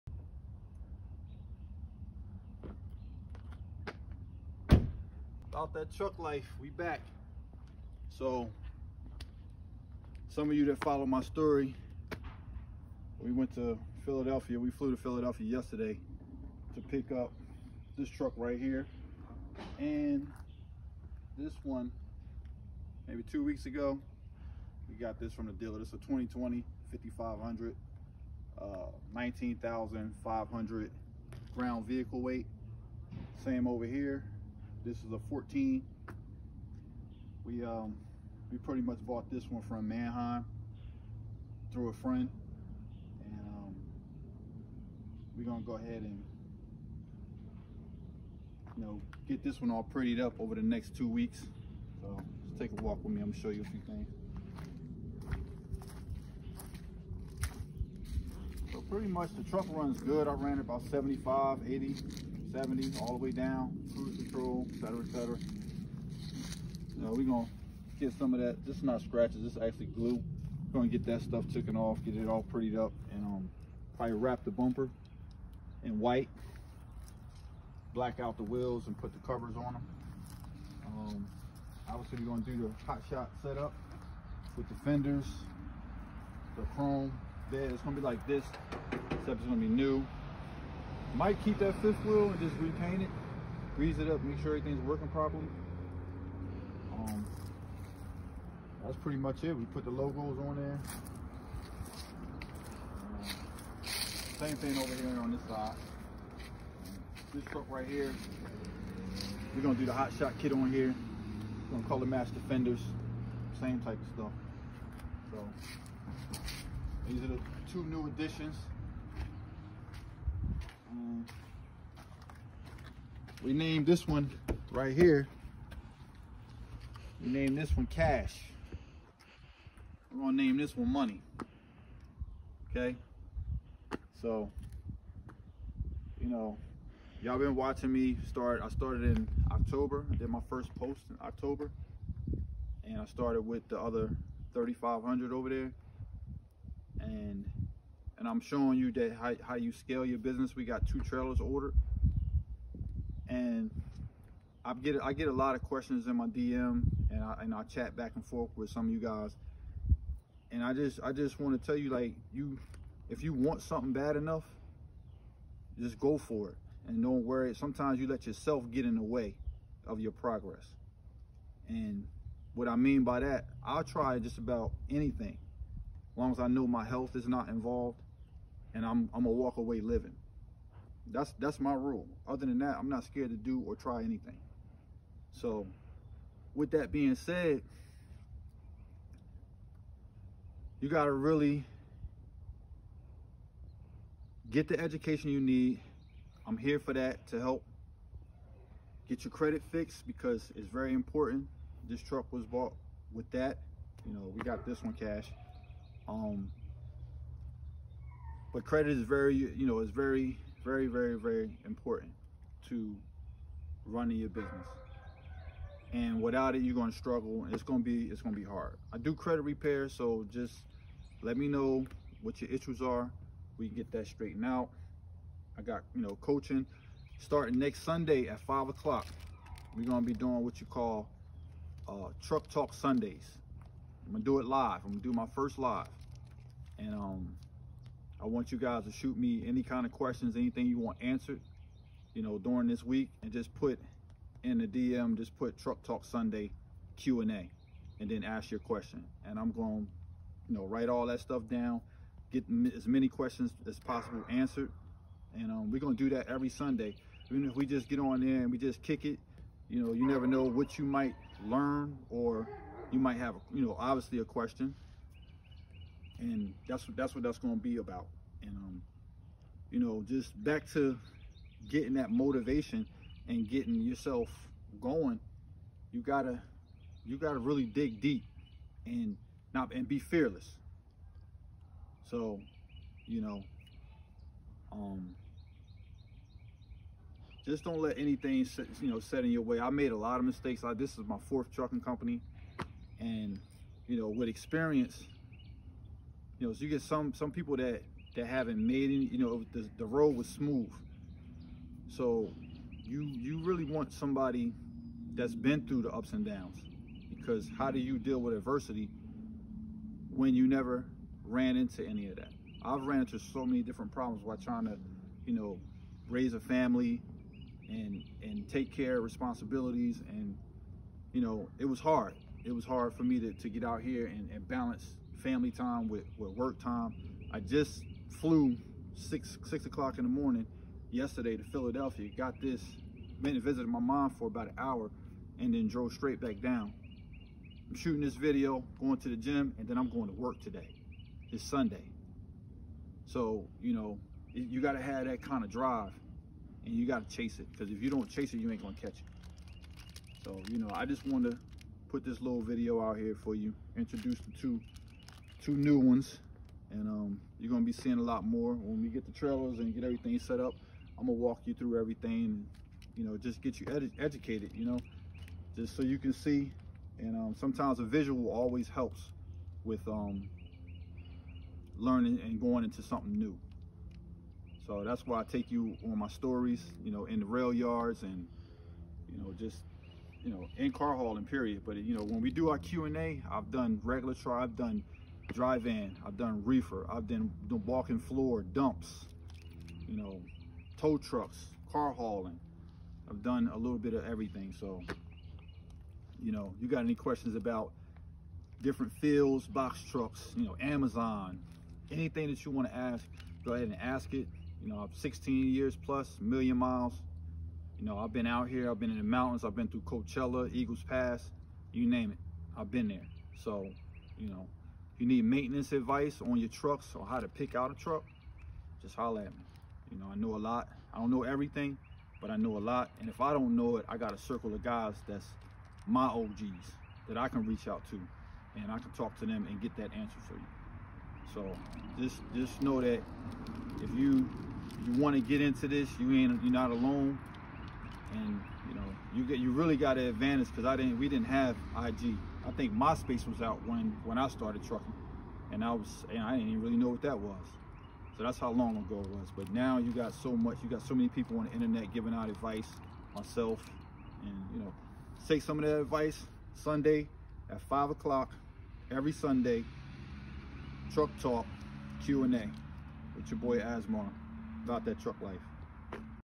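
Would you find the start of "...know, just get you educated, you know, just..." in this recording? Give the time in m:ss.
6:03.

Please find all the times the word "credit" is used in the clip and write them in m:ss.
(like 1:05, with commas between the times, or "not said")
3:19, 3:28, 3:39.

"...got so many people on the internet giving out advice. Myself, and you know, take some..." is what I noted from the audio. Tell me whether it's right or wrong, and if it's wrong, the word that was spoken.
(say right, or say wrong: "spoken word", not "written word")
right.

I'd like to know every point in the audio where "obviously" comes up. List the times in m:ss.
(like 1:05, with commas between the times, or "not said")
1:21, 4:23.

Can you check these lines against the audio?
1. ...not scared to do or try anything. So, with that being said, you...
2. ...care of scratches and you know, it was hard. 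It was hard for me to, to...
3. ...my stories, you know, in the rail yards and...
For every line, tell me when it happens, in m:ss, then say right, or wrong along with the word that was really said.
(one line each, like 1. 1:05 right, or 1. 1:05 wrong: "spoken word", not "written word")
1. 3:02 right
2. 5:18 wrong: "responsibilities", not "scratches"
3. 6:15 right.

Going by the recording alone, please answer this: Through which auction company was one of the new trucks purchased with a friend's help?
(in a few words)
Manheim.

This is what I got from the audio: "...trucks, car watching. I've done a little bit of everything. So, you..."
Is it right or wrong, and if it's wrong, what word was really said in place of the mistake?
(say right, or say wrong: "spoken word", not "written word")
wrong: "hauling", not "watching".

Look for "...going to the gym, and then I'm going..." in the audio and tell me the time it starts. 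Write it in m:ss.
5:38.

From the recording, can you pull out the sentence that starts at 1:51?
We're gonna color match the fenders, same type of stuff.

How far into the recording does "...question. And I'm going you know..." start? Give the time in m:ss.
4:08.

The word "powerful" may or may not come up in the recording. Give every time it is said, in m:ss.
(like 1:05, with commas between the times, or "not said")
not said.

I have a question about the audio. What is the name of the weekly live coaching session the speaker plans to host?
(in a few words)
Truck Talk Sundays.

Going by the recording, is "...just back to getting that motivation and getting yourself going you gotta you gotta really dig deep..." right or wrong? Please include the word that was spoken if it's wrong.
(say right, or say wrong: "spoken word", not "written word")
right.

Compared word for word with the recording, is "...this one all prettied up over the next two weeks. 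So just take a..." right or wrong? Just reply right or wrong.
right.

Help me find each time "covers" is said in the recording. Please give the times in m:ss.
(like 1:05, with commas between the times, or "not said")
1:19.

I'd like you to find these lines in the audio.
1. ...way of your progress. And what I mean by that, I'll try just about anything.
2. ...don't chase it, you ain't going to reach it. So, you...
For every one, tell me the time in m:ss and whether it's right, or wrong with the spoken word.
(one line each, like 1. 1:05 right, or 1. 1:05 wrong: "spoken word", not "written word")
1. 2:49 right
2. 5:47 wrong: "catch", not "reach".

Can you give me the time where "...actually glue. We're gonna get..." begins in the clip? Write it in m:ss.
1:09.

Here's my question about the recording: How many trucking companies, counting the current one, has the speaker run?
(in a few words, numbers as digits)
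4.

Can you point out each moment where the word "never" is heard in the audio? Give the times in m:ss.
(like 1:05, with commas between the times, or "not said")
4:20, 5:10.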